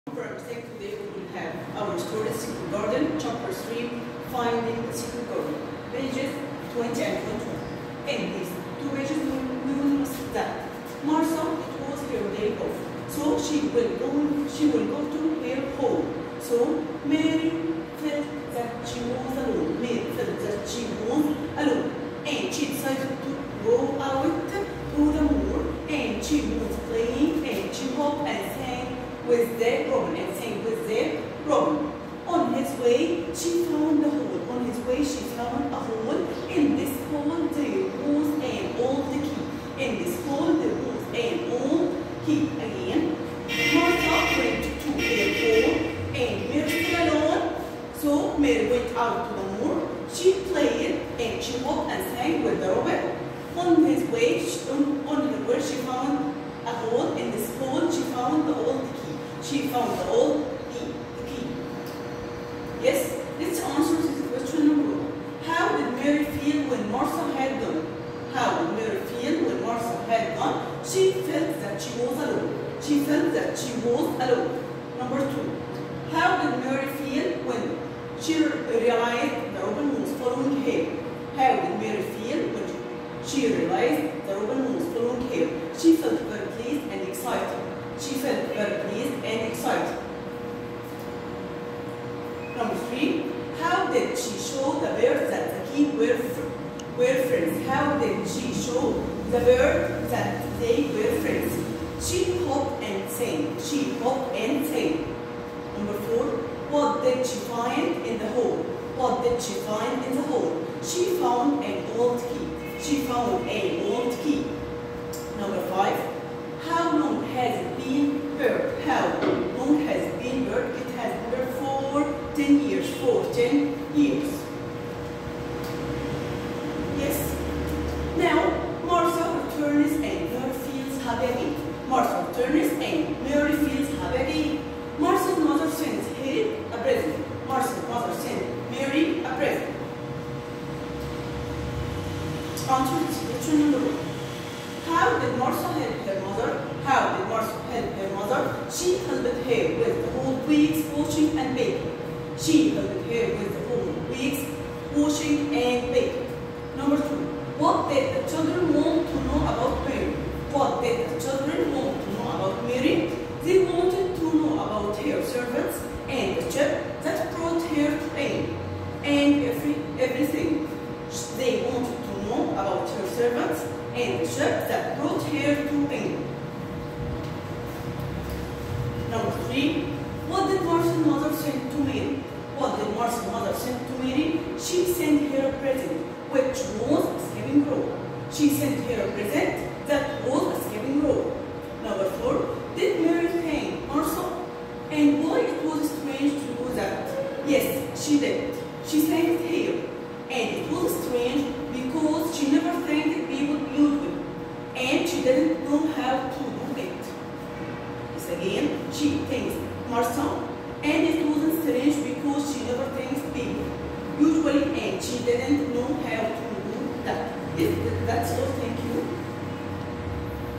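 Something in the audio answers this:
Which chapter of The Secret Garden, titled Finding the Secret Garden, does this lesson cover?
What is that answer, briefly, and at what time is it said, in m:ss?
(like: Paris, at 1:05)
3, at 0:03.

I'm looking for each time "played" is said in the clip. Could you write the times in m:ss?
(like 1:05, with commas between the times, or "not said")
0:50.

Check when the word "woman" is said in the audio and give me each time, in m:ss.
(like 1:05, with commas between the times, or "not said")
1:19, 1:24.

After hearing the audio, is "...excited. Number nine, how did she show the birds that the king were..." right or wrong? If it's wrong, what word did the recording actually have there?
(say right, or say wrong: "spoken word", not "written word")
wrong: "three", not "nine".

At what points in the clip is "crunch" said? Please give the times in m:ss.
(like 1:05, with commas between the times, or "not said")
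not said.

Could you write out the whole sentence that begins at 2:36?
Number two, what did the children want and the chip that brought her pain and every, everything.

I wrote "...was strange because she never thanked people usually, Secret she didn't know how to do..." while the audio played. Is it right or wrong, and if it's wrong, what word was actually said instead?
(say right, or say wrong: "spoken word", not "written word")
wrong: "And", not "Secret".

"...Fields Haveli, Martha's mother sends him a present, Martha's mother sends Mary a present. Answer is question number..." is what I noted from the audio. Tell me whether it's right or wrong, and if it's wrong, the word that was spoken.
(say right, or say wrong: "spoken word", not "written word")
right.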